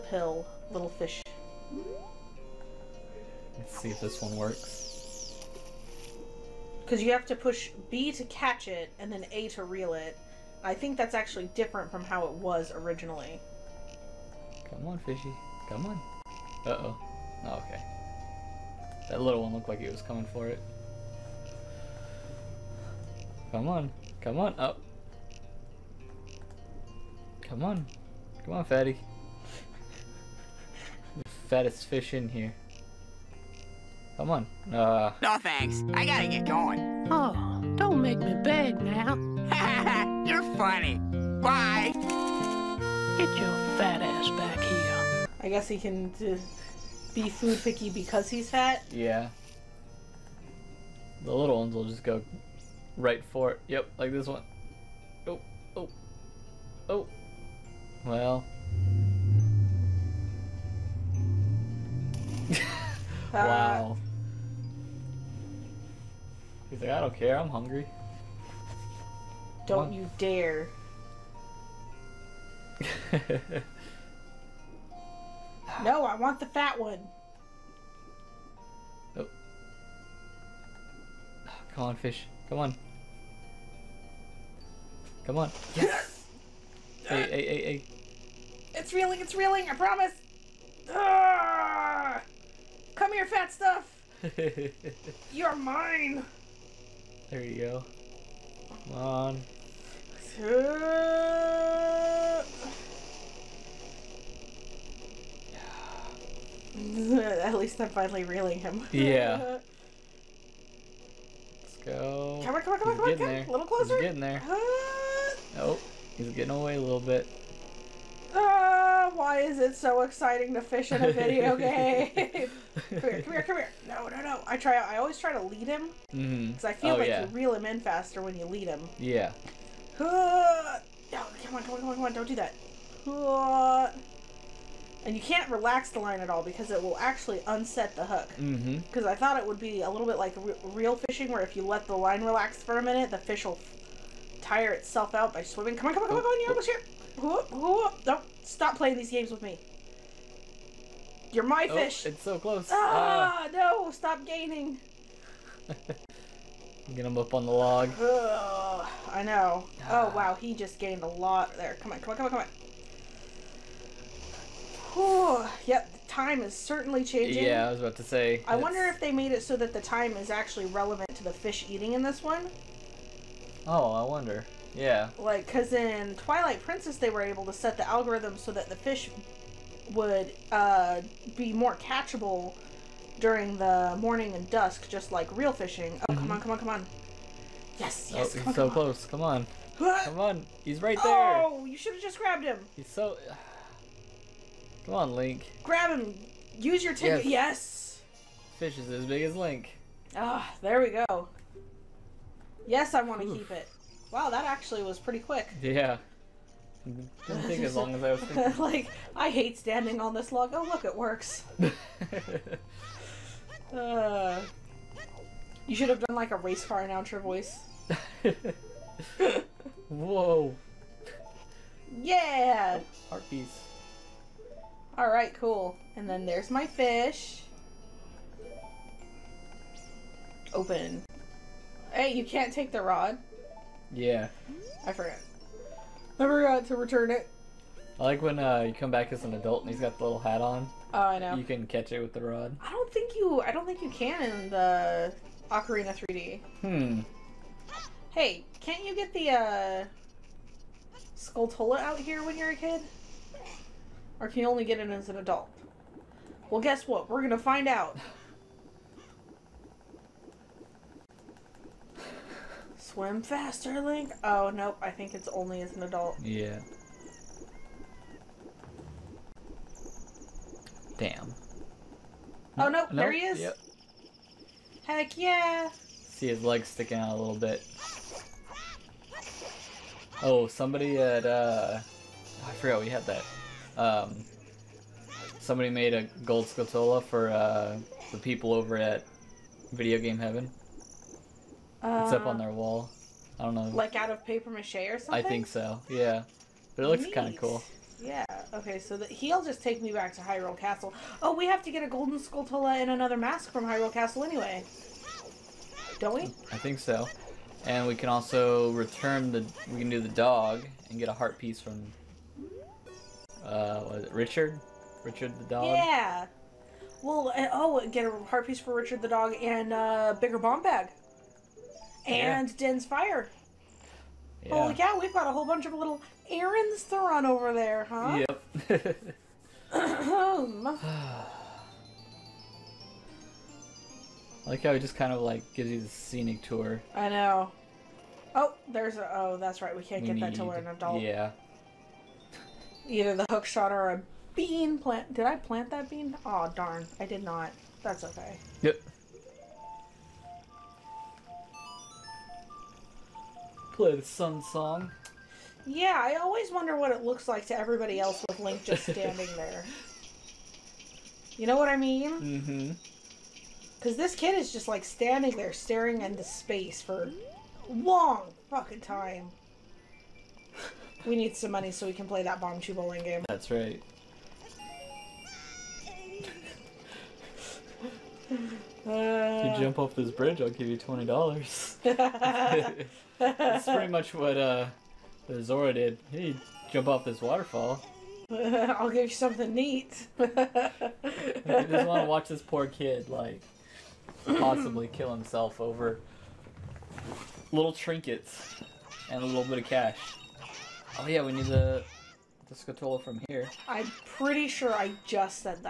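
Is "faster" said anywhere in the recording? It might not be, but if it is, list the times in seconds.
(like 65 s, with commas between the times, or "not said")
127 s, 263 s.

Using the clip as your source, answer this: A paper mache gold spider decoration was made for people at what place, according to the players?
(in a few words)
Video Game Heaven.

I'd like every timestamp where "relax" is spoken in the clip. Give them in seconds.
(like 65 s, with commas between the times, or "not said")
135 s, 142 s.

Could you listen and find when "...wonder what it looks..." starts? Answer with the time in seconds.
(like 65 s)
356 s.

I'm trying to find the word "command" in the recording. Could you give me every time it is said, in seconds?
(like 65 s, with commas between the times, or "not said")
not said.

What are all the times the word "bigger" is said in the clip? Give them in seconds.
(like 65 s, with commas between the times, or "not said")
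320 s.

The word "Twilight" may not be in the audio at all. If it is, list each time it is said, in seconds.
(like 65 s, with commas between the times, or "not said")
176 s.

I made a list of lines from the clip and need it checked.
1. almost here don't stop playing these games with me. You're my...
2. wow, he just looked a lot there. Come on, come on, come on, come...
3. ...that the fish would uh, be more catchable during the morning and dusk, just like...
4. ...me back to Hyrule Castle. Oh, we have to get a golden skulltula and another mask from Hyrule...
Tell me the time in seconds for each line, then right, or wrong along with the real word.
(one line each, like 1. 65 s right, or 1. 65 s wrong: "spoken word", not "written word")
1. 146 s right
2. 160 s wrong: "gained", not "looked"
3. 178 s right
4. 299 s right.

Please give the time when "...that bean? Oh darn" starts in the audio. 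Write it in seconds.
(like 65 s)
345 s.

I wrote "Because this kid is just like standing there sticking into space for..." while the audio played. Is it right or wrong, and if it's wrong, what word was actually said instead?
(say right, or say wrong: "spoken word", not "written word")
wrong: "staring", not "sticking".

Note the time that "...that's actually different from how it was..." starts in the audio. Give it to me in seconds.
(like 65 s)
10 s.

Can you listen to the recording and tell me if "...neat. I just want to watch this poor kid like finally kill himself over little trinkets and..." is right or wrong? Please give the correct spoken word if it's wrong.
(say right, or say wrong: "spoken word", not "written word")
wrong: "possibly", not "finally".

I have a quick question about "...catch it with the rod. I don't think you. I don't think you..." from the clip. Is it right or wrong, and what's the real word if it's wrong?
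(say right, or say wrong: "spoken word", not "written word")
right.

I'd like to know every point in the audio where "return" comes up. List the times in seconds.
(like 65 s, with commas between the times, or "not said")
236 s, 308 s.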